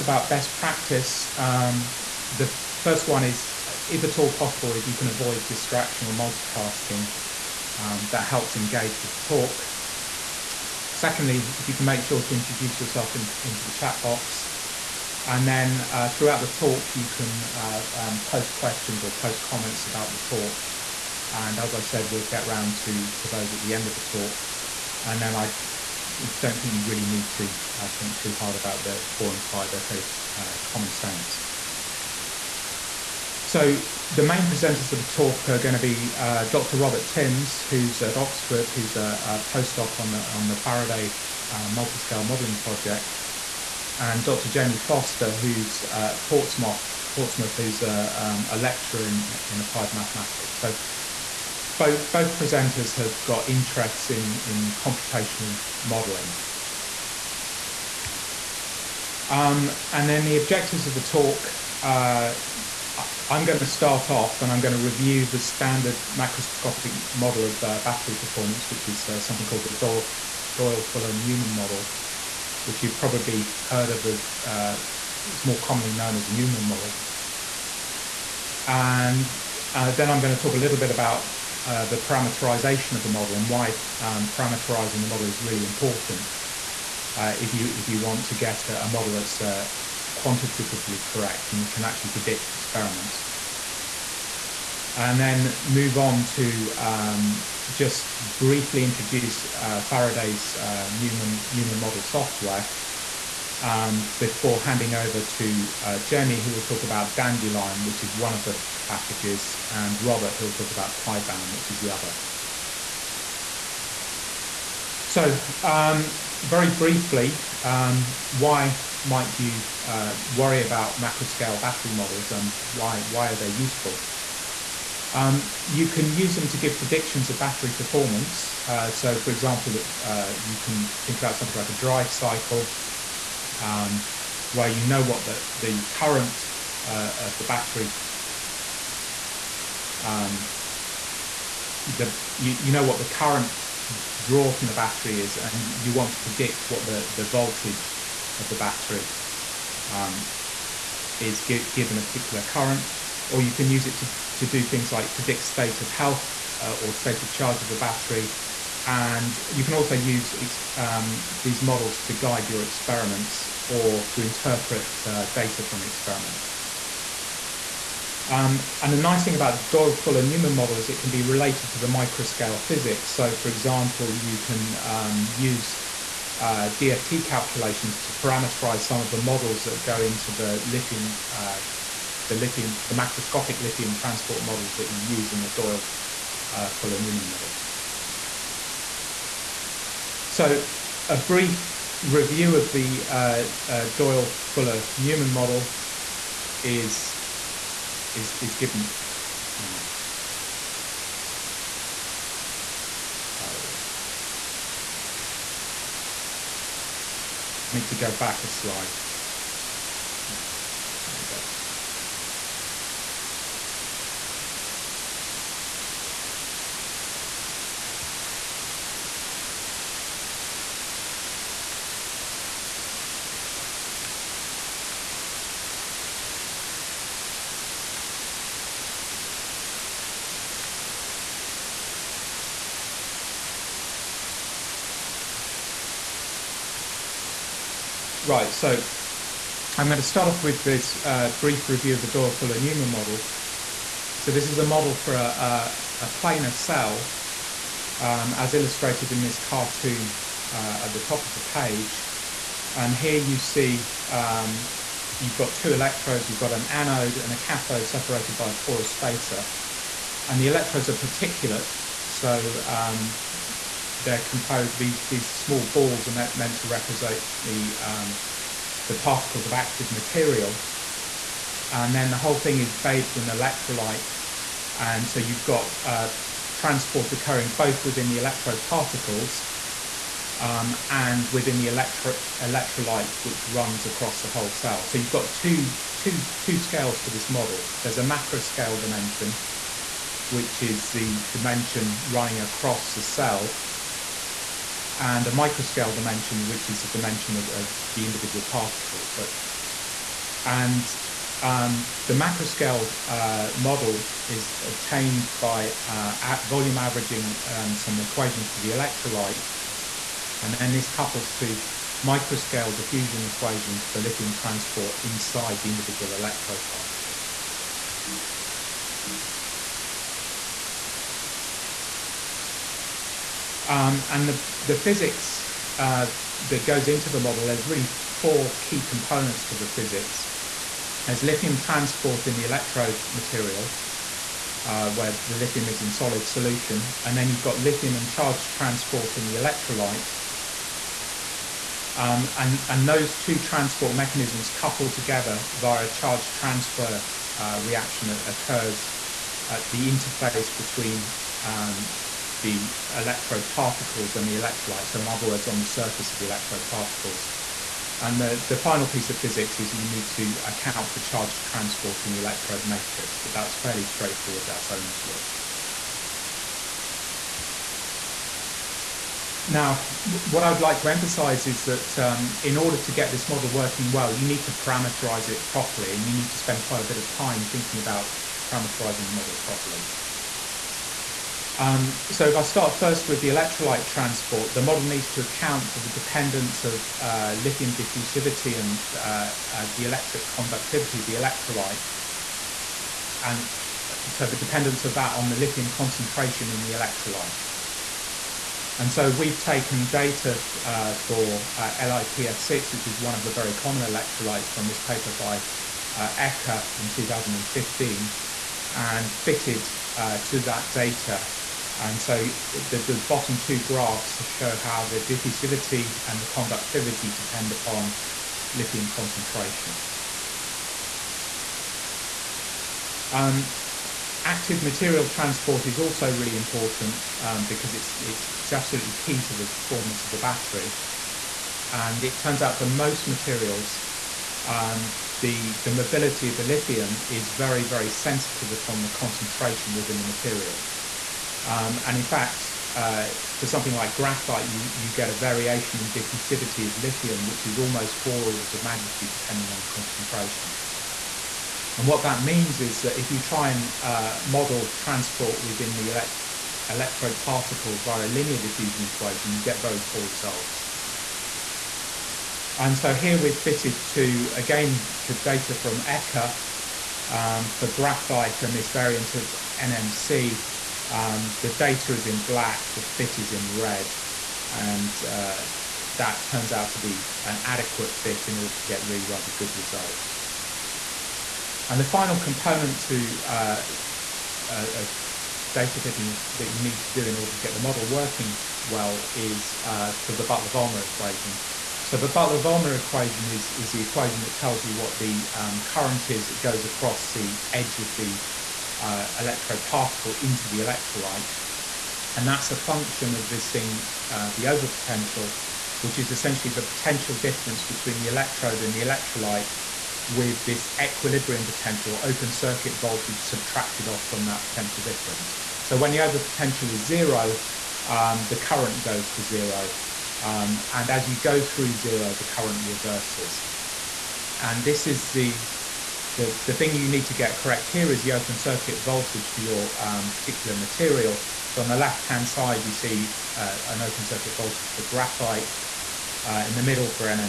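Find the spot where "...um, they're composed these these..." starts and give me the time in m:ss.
4:22.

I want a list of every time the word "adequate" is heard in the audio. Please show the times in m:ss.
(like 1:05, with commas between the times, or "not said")
7:57.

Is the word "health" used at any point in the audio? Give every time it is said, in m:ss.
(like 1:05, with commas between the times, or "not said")
2:35.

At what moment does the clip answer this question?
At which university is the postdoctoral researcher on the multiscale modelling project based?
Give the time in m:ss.
0:38.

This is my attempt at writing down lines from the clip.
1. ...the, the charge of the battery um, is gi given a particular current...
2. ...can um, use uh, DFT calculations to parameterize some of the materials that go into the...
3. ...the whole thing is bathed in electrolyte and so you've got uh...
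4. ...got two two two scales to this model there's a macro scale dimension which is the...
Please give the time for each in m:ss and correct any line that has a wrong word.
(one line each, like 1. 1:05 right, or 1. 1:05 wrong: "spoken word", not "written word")
1. 2:26 wrong: "voltage", not "charge"
2. 2:54 wrong: "models", not "materials"
3. 4:32 right
4. 4:45 right.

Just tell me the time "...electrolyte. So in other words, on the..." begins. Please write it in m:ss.
5:54.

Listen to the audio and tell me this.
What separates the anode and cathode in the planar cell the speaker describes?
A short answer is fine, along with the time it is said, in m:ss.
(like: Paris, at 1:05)
a porous spacer, at 4:18.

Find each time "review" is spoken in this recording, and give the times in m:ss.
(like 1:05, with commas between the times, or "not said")
1:04, 3:12, 4:01.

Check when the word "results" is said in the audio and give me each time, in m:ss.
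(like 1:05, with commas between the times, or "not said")
7:40, 7:59.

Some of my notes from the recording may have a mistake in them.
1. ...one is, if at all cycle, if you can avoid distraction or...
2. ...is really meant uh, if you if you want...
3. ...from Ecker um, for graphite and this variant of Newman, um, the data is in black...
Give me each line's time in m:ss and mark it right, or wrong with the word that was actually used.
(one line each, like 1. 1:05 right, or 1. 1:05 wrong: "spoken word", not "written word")
1. 0:03 wrong: "possible", not "cycle"
2. 1:25 wrong: "important", not "meant"
3. 7:45 wrong: "NMC", not "Newman".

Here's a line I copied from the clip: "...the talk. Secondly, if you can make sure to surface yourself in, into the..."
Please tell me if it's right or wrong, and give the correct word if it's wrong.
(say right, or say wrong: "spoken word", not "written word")
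wrong: "introduce", not "surface".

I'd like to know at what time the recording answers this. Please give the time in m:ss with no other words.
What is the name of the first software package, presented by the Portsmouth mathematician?
1:47.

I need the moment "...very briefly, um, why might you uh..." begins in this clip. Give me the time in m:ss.
1:56.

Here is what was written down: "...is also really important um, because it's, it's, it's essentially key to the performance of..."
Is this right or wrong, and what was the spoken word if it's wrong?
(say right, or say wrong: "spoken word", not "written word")
wrong: "absolutely", not "essentially".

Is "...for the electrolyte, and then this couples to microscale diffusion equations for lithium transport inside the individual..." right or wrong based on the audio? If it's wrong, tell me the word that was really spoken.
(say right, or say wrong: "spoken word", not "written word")
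right.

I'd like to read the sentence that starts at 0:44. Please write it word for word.
Jamie Foster, who's Portsmouth, Portsmouth who's a, um, a lecturer in, in applied mathematics.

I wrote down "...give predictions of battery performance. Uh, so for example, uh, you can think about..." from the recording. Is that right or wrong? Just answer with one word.
right.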